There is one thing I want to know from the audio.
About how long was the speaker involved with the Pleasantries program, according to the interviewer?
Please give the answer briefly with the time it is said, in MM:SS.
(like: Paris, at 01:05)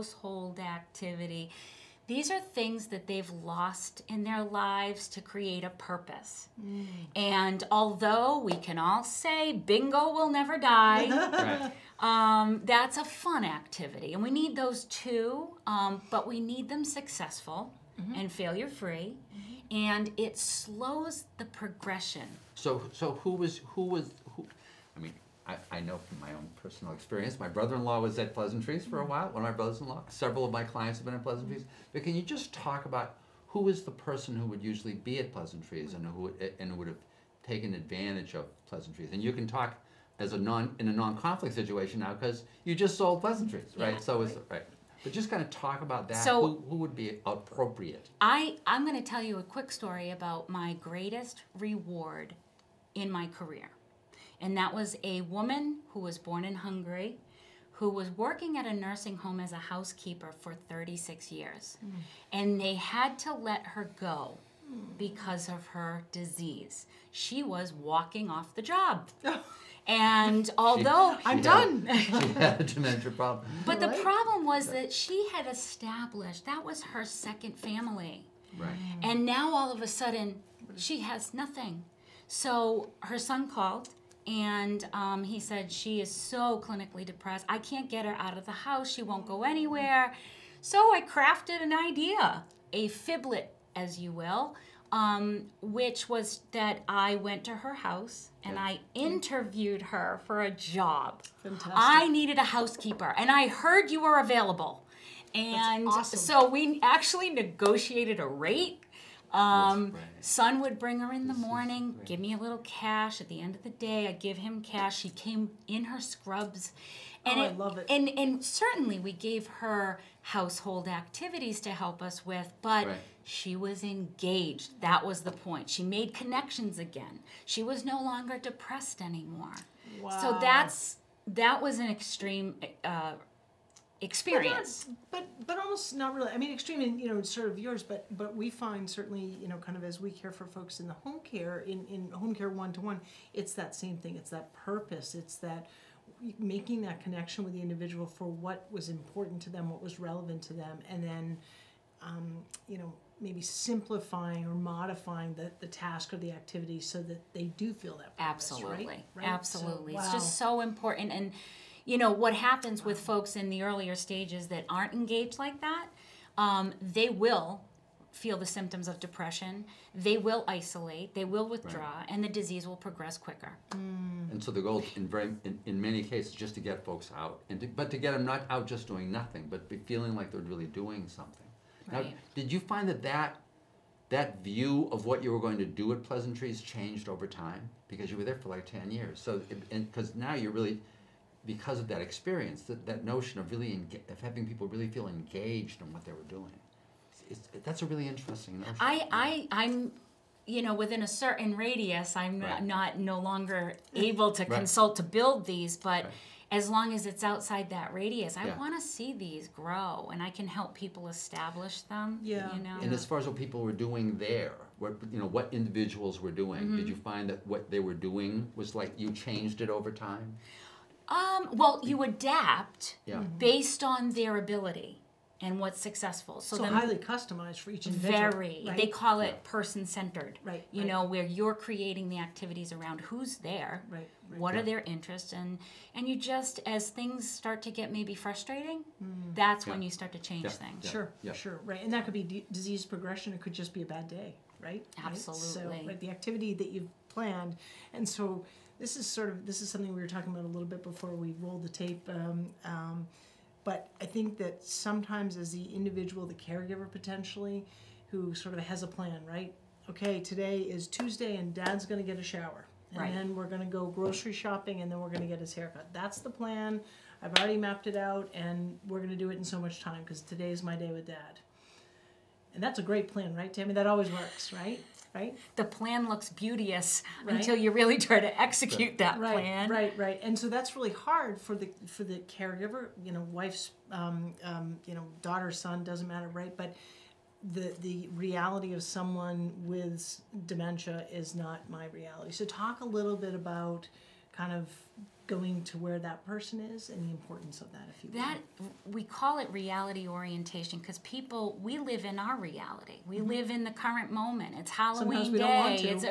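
10 years, at 03:08.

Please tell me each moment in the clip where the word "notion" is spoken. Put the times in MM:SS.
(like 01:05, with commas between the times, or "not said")
03:13, 03:18.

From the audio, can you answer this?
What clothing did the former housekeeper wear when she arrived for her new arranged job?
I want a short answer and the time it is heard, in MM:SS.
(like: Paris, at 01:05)
Scrubs, at 01:55.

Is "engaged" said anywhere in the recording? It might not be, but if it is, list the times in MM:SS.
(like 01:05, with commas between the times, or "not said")
02:03, 02:44, 03:15.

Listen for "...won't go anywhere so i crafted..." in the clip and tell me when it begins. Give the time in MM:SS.
01:29.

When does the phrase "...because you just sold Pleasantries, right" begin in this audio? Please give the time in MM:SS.
00:42.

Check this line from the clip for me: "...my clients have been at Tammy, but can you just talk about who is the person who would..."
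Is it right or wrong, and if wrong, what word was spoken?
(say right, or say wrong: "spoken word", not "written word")
wrong: "Pleasantries", not "Tammy".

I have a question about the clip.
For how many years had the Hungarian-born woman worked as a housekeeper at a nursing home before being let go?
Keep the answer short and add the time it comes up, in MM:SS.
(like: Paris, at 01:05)
36, at 01:00.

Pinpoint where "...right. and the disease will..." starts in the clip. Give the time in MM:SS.
02:51.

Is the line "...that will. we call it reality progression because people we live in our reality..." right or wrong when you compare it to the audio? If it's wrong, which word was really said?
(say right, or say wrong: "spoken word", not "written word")
wrong: "orientation", not "progression".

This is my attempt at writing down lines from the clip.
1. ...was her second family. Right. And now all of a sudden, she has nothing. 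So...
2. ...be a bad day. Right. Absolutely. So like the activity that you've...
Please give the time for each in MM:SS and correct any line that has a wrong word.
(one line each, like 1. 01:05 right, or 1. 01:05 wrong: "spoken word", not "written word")
1. 01:16 right
2. 04:03 right.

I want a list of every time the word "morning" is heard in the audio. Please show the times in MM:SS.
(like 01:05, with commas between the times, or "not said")
01:51.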